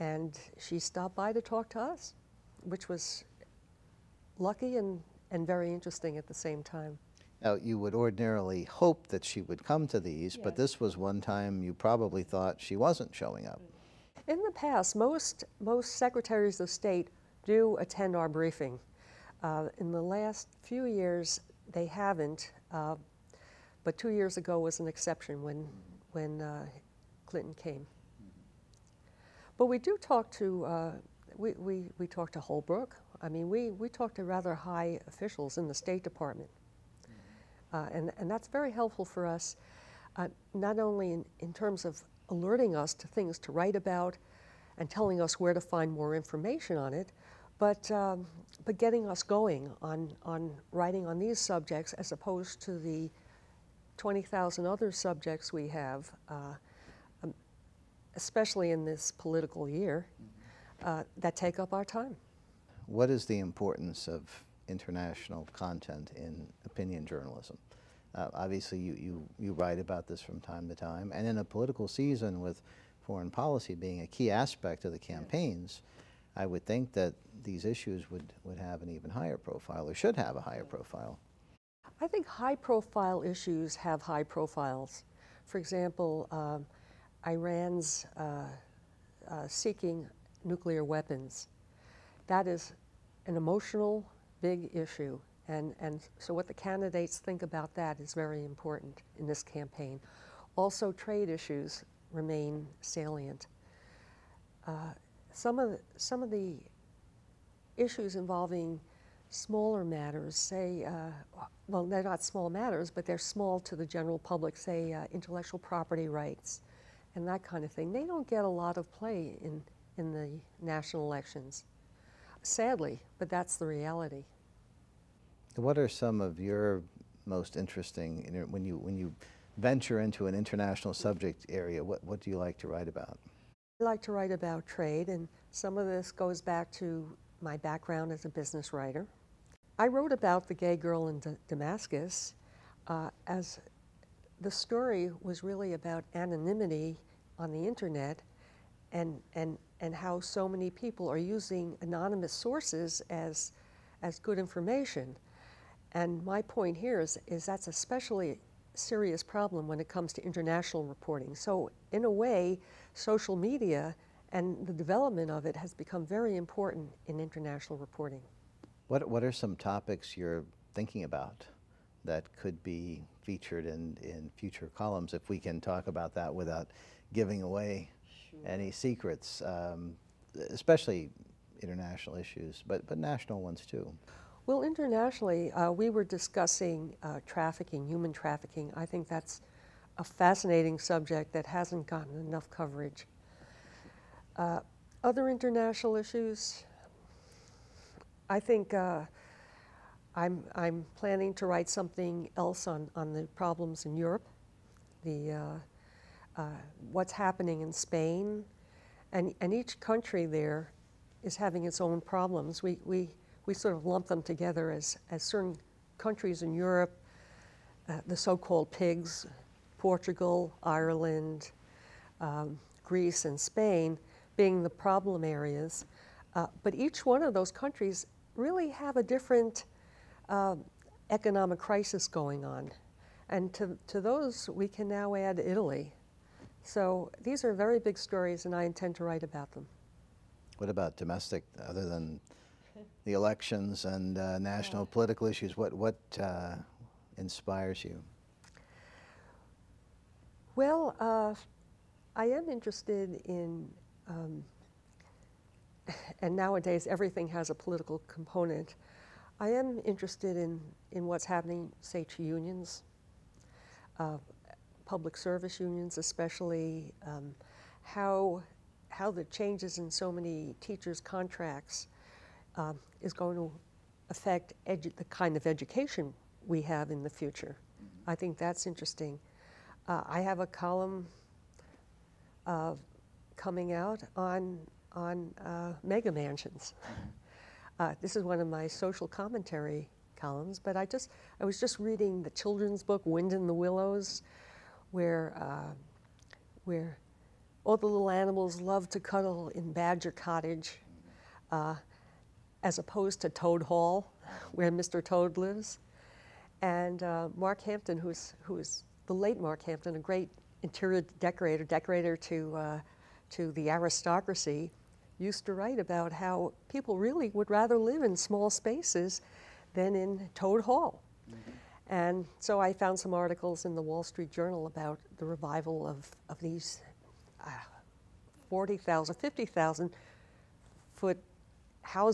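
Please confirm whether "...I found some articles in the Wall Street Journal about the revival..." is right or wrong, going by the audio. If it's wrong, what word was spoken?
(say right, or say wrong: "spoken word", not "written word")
right.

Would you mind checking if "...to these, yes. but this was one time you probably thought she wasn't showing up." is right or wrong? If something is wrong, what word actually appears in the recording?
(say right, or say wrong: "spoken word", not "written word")
right.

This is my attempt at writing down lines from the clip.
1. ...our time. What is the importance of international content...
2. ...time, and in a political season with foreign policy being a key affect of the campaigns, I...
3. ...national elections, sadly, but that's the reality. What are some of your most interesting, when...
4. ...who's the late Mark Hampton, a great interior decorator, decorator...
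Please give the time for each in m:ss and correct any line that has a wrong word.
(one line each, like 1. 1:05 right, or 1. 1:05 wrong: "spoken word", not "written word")
1. 1:01 right
2. 1:10 wrong: "aspect", not "affect"
3. 2:00 right
4. 5:08 right.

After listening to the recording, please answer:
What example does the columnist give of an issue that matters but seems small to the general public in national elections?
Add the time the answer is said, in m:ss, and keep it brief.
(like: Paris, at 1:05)
intellectual property rights, at 1:55.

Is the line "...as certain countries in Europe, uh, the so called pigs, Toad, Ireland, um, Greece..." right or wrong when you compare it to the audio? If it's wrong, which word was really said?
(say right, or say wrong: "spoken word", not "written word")
wrong: "Portugal", not "Toad".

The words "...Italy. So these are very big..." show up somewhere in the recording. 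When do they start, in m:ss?
3:55.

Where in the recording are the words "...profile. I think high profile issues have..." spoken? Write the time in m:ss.
1:20.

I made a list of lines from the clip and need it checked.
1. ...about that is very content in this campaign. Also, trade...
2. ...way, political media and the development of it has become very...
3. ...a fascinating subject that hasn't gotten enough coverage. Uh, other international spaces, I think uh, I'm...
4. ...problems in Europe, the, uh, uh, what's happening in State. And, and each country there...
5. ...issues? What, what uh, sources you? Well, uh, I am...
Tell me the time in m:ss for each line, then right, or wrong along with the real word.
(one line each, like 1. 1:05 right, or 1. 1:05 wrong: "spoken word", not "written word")
1. 1:37 wrong: "important", not "content"
2. 2:42 wrong: "social", not "political"
3. 3:09 wrong: "issues", not "spaces"
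4. 3:23 wrong: "Spain", not "State"
5. 4:05 wrong: "inspires", not "sources".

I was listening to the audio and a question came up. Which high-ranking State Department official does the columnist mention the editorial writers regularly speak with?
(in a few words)
Holbrooke.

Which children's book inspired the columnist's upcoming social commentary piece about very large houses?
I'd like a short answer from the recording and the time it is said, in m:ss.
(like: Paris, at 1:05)
Wind in the Willows, at 4:53.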